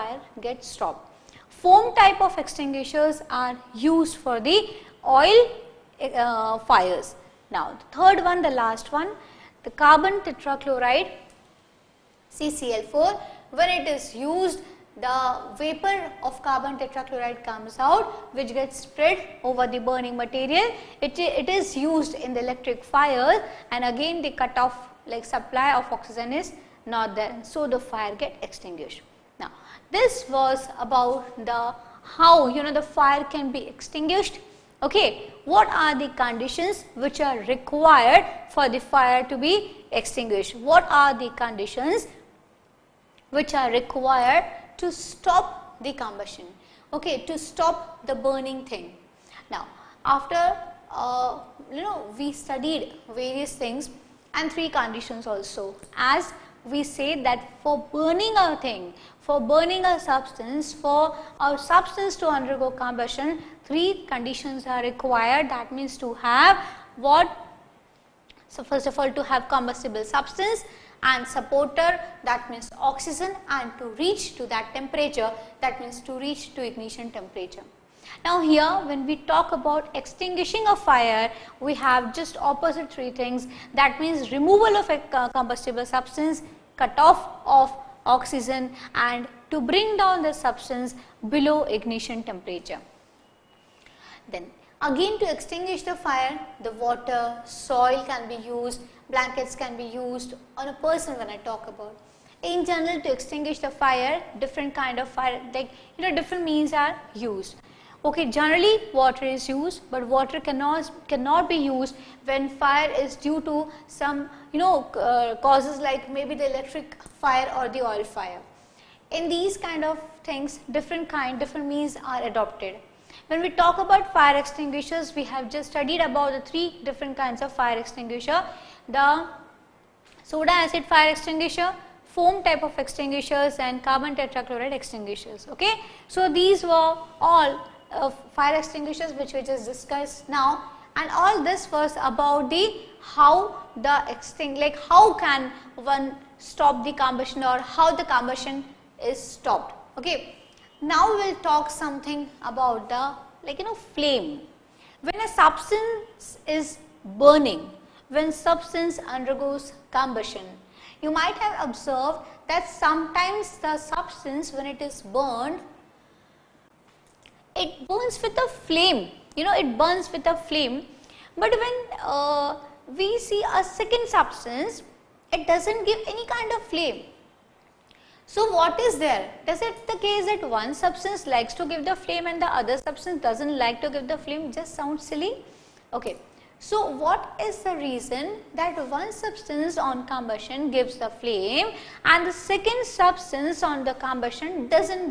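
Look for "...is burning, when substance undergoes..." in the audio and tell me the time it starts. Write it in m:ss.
2:36.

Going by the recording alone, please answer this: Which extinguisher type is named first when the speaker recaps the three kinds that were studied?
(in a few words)
soda acid.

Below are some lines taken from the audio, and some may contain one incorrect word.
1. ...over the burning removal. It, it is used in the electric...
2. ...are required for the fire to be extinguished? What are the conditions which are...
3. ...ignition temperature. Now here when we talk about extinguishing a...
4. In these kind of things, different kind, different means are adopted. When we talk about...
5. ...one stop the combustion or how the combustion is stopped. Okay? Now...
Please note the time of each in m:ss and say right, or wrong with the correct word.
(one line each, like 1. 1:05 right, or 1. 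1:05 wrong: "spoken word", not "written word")
1. 0:19 wrong: "material", not "removal"
2. 0:37 right
3. 1:16 right
4. 1:59 right
5. 2:25 right.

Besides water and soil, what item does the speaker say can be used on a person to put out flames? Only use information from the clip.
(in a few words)
blankets.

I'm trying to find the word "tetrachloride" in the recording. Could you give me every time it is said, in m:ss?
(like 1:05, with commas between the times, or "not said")
0:10, 0:16, 2:14.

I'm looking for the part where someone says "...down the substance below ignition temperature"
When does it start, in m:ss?
1:29.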